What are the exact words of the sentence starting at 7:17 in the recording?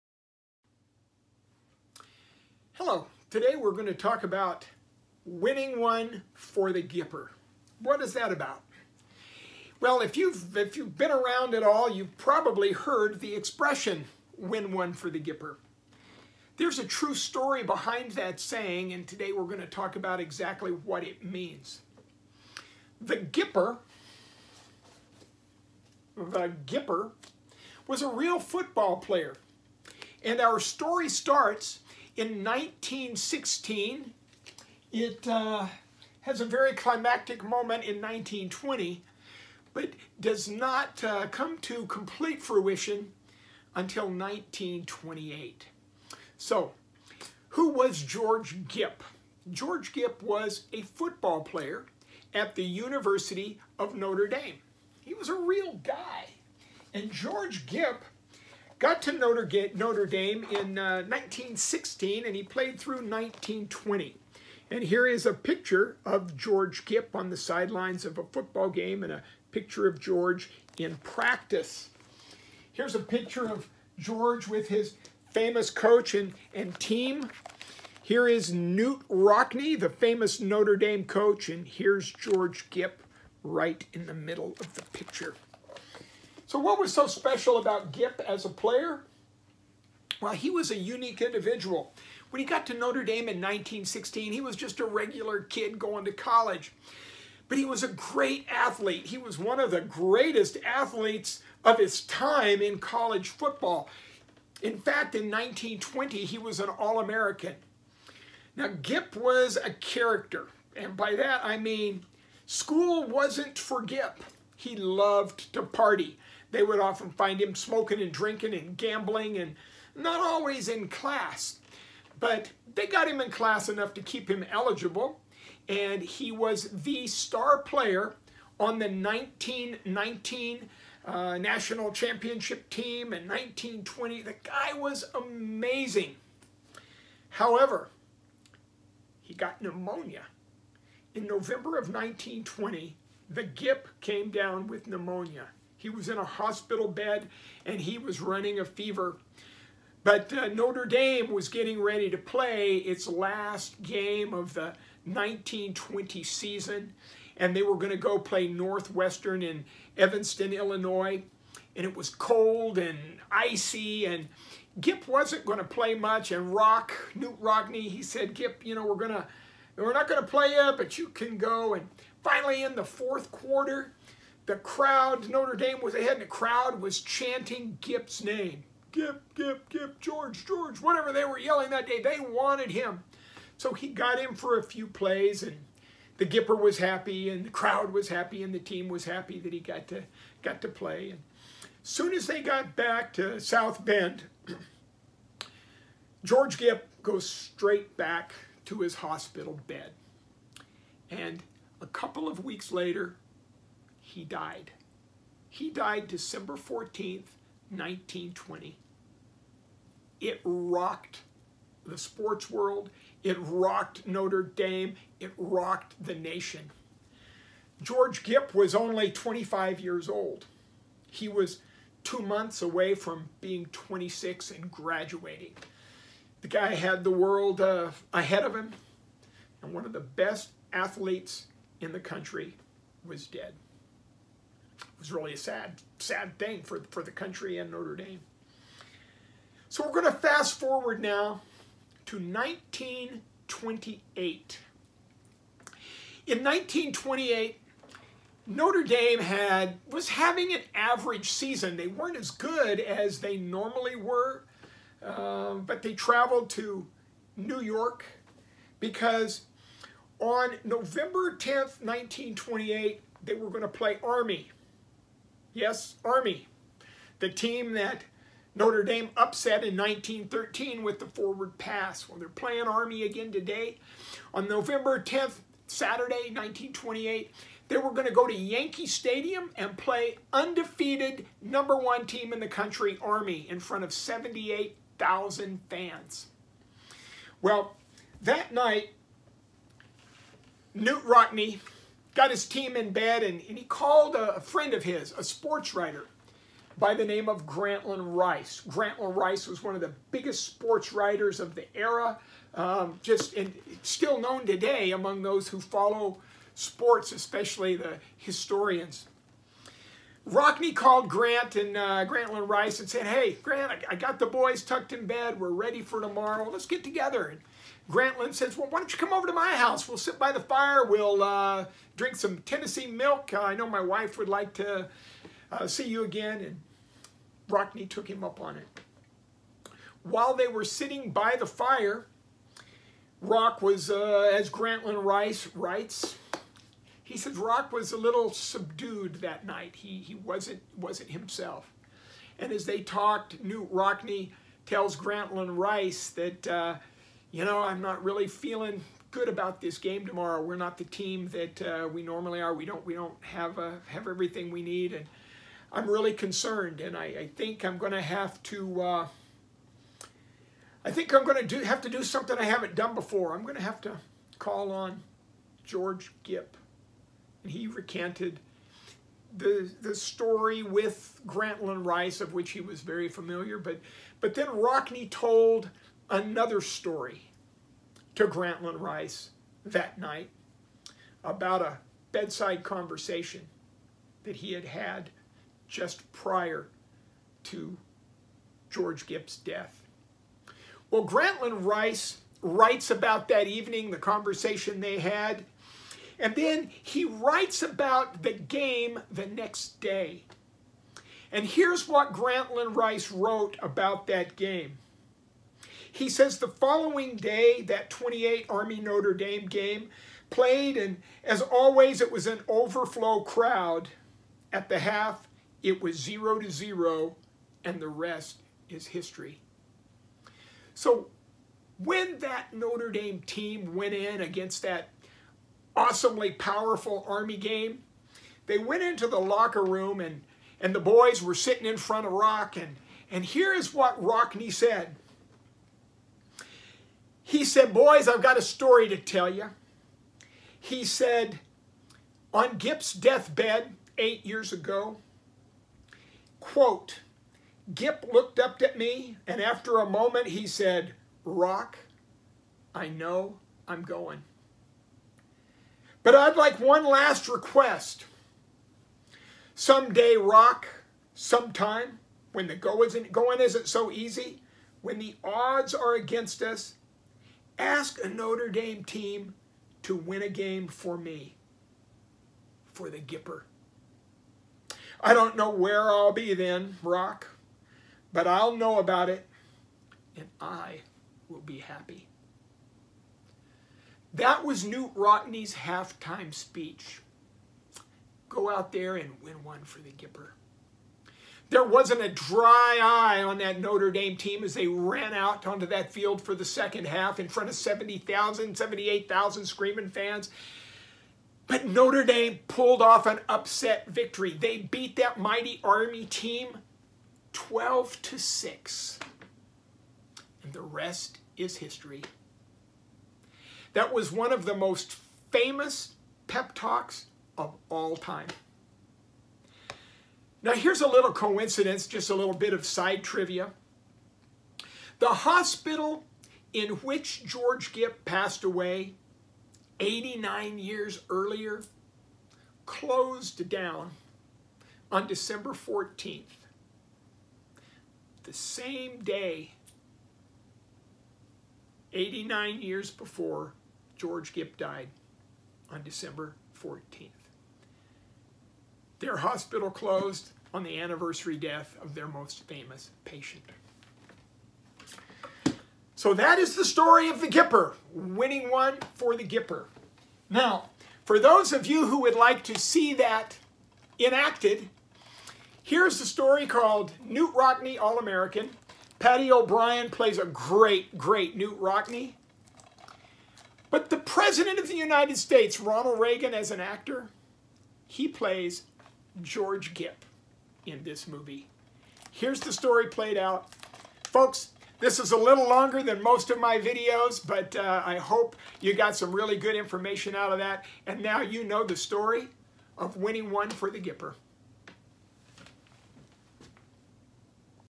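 He said, boys, I've got a story to tell you.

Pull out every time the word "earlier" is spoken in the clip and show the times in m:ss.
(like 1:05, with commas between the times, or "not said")
8:51.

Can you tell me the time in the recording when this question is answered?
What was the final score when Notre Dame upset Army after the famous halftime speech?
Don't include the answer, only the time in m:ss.
8:27.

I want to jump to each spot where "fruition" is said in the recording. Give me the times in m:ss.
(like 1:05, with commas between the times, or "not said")
0:42.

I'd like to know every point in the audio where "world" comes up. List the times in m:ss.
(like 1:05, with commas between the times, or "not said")
3:32, 3:47.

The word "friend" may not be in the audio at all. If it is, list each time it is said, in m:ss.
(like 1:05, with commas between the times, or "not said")
4:54.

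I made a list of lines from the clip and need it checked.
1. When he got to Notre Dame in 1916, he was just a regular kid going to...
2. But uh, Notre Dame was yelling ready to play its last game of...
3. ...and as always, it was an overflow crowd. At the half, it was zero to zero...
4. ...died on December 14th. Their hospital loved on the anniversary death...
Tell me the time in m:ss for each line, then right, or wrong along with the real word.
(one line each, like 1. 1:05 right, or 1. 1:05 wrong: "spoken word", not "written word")
1. 1:32 right
2. 2:30 wrong: "getting", not "yelling"
3. 6:50 right
4. 9:04 wrong: "closed", not "loved".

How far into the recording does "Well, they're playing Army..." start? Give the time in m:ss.
4:32.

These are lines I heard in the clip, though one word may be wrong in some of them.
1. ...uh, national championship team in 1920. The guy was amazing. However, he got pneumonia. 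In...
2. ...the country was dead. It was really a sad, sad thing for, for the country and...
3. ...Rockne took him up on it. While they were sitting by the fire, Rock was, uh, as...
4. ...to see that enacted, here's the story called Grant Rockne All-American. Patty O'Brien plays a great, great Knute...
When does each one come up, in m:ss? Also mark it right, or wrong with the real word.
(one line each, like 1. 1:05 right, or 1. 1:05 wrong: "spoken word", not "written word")
1. 2:11 right
2. 3:51 right
3. 5:27 right
4. 9:22 wrong: "Knute", not "Grant".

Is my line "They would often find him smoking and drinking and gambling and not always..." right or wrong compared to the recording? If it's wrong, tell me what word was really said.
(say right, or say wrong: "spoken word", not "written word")
right.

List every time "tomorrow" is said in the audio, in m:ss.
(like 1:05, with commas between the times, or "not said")
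5:15, 5:50.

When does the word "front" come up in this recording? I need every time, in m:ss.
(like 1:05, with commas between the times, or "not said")
4:43, 7:11, 8:17.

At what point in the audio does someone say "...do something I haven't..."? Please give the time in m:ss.
6:01.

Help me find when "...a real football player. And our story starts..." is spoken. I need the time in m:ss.
0:28.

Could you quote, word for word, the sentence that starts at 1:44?
In fact, in 1920, he was an All-American.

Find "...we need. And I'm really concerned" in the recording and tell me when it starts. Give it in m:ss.
5:54.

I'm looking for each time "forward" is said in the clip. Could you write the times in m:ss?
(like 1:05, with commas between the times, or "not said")
4:00, 4:31.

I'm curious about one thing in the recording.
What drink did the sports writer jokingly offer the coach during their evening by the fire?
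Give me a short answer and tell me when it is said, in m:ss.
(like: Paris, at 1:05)
Tennessee milk, at 5:22.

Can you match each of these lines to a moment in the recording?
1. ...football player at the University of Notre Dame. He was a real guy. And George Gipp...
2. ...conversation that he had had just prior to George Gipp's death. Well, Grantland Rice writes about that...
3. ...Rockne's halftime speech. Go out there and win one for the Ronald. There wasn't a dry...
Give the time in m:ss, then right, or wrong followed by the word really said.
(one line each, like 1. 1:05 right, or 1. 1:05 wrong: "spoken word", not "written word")
1. 0:50 right
2. 6:22 right
3. 8:04 wrong: "Gipper", not "Ronald".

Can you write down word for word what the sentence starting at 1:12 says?
Here's a picture of George with his famous coach and, and team.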